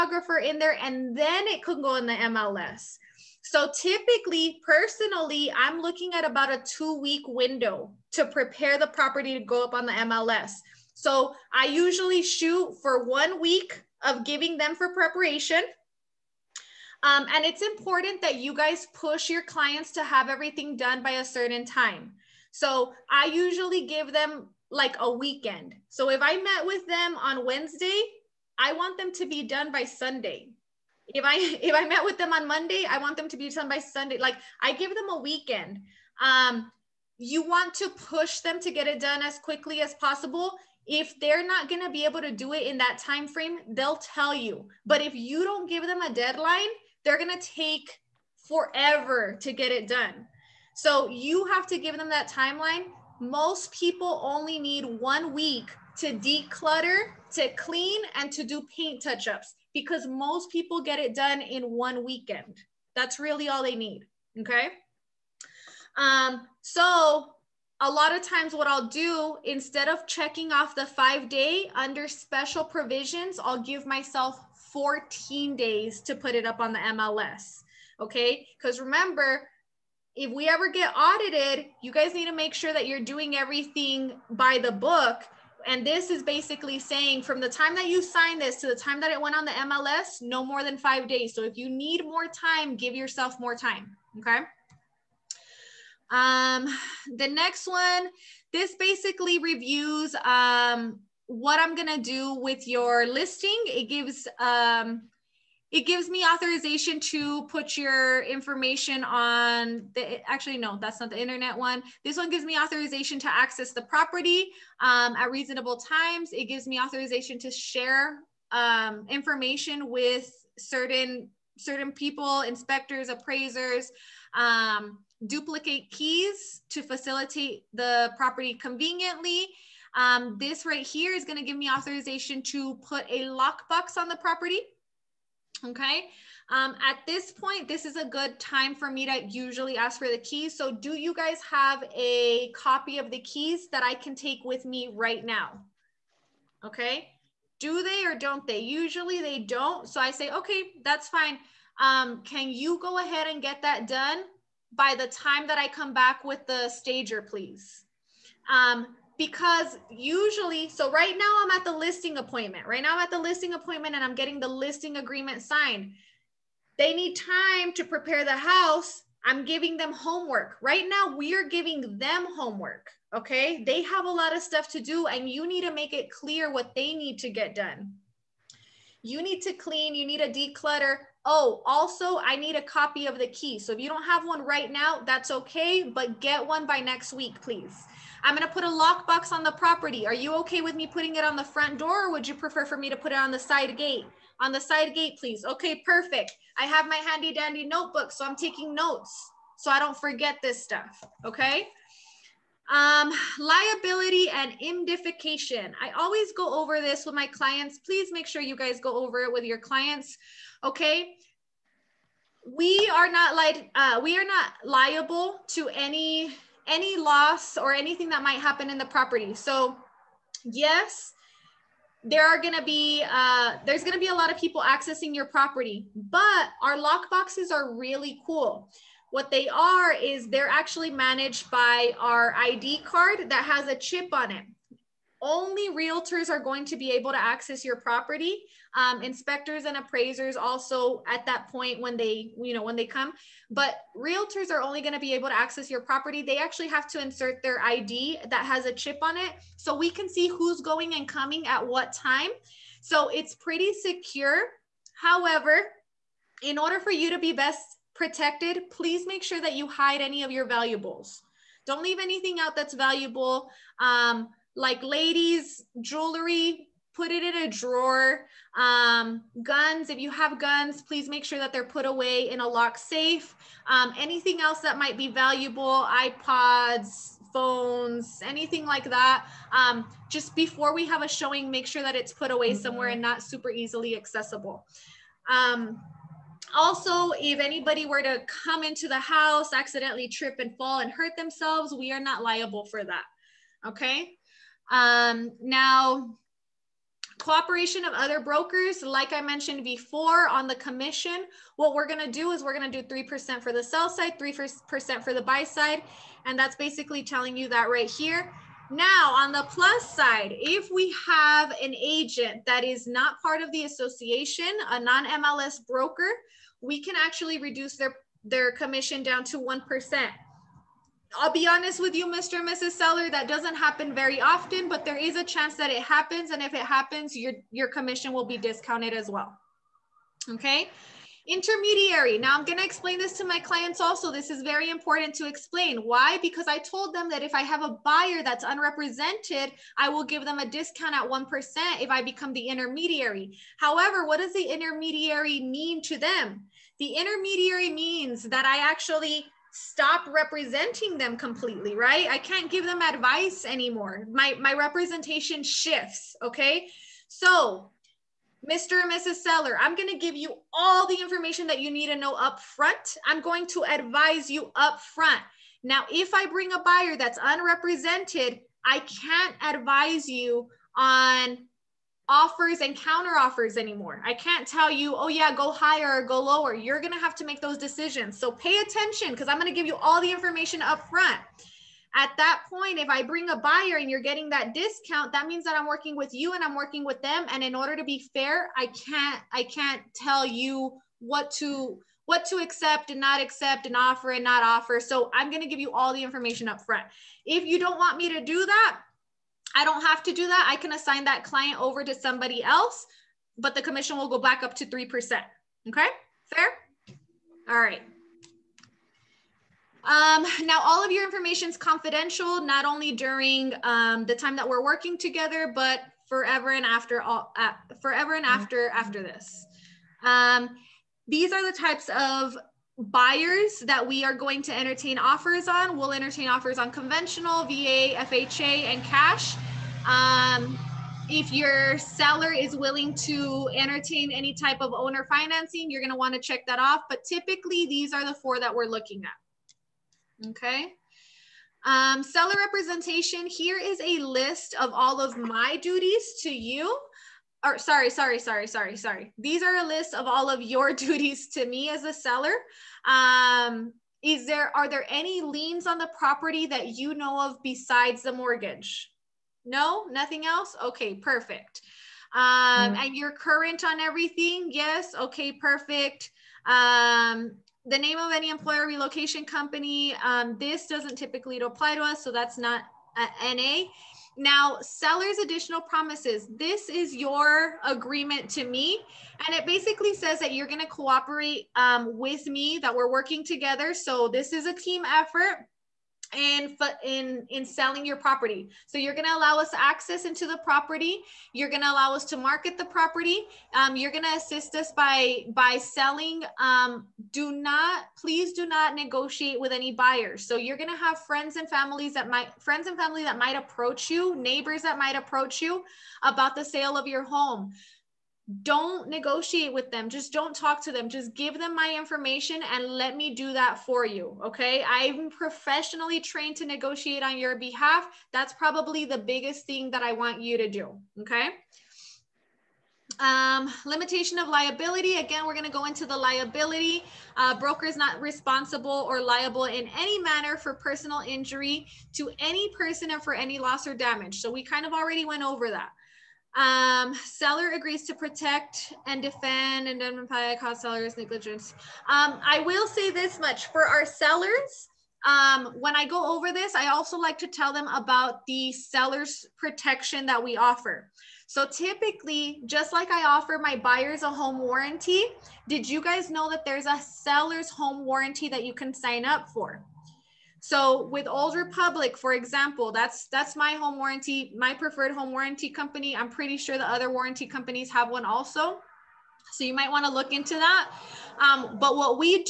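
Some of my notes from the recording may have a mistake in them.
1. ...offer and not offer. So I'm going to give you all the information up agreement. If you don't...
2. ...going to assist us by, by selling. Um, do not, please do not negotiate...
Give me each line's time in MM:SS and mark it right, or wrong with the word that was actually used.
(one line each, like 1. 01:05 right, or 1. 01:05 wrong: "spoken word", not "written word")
1. 06:33 wrong: "front", not "agreement"
2. 08:13 right.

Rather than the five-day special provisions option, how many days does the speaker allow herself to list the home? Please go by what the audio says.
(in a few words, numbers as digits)
14 days.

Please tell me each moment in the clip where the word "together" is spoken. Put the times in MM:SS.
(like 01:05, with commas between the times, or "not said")
06:54, 08:03.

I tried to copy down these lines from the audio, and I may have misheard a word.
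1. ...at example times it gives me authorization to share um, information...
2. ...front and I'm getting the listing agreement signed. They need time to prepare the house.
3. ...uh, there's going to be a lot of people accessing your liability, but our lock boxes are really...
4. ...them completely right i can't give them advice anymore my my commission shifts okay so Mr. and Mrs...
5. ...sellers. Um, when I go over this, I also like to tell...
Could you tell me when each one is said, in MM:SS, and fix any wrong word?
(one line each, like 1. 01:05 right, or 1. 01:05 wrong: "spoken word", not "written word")
1. 01:55 wrong: "reasonable", not "example"
2. 02:43 wrong: "appointment", not "front"
3. 03:43 wrong: "property", not "liability"
4. 05:50 wrong: "representation", not "commission"
5. 09:03 right.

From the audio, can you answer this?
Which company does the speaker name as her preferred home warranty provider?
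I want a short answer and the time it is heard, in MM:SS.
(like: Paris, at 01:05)
Old Republic, at 09:21.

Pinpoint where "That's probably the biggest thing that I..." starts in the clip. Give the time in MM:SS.
08:38.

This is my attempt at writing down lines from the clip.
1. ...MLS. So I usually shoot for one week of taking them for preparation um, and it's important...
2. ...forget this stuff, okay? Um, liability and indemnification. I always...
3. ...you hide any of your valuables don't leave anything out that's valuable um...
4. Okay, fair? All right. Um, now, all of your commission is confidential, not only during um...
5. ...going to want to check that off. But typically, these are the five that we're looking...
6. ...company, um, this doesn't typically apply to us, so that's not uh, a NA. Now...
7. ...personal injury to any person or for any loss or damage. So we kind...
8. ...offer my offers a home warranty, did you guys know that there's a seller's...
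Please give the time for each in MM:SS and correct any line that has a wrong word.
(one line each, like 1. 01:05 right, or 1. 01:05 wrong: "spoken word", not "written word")
1. 00:09 wrong: "giving", not "taking"
2. 03:19 right
3. 04:19 right
4. 06:45 wrong: "information", not "commission"
5. 07:15 wrong: "four", not "five"
6. 07:49 right
7. 08:50 right
8. 09:13 wrong: "buyers", not "offers".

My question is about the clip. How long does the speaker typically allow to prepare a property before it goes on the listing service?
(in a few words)
two week window.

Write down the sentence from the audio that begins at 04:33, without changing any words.
Um, anything else that might be valuable, iPods, phones, anything like that.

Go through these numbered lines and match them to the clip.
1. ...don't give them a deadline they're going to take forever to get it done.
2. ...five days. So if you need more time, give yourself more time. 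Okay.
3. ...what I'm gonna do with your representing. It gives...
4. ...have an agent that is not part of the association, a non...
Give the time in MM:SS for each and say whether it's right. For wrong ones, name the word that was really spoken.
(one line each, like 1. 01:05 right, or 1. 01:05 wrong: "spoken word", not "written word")
1. 00:45 right
2. 01:30 right
3. 01:41 wrong: "listing", not "representing"
4. 05:11 right.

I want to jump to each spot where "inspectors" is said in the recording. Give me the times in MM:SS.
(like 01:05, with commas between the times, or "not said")
02:02, 03:59.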